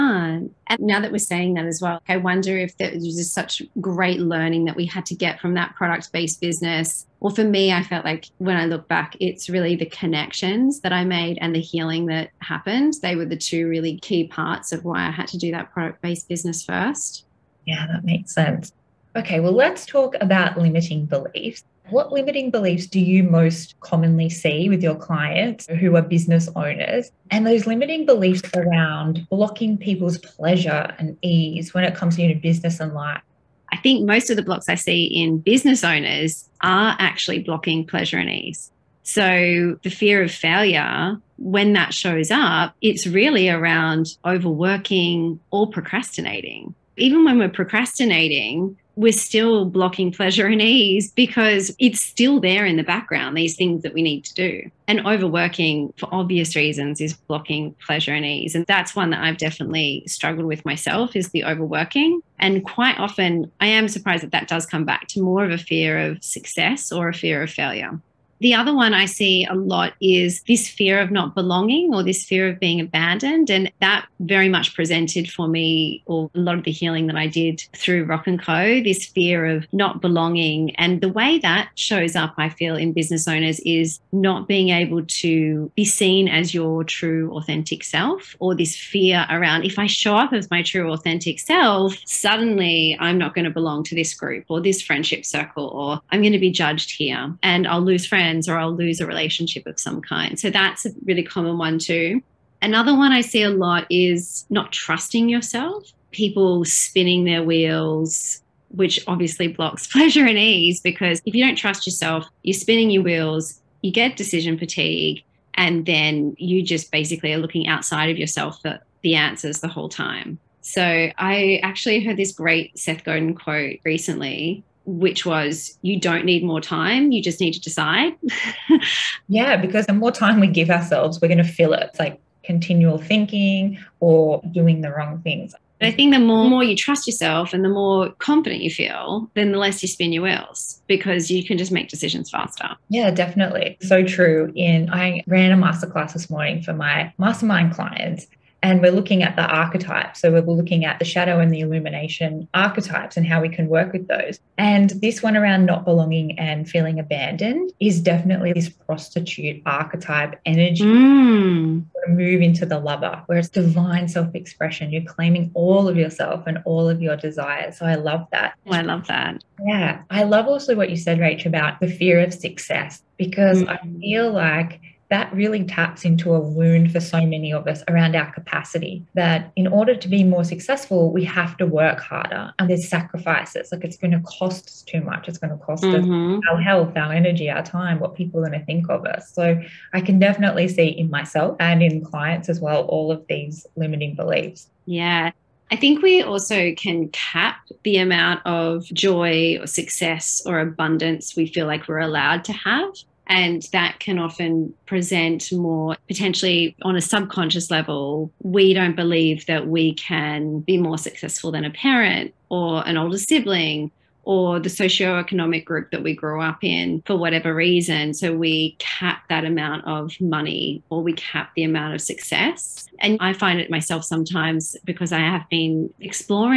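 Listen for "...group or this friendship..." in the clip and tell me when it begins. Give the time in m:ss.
1:34.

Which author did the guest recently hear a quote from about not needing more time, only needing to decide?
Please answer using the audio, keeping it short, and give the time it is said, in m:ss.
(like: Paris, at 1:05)
Seth Godin, at 2:02.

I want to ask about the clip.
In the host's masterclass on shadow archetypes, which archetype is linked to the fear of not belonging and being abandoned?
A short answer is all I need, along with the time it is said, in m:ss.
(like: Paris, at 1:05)
prostitute, at 2:38.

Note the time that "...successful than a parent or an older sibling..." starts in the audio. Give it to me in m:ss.
3:30.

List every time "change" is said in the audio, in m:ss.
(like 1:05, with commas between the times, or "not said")
not said.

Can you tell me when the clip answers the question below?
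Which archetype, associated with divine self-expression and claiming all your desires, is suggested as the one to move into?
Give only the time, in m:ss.
2:42.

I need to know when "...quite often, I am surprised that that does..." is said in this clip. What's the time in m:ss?
1:02.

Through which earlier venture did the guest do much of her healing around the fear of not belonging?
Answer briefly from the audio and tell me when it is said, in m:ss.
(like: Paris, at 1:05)
Rock and Co, at 1:18.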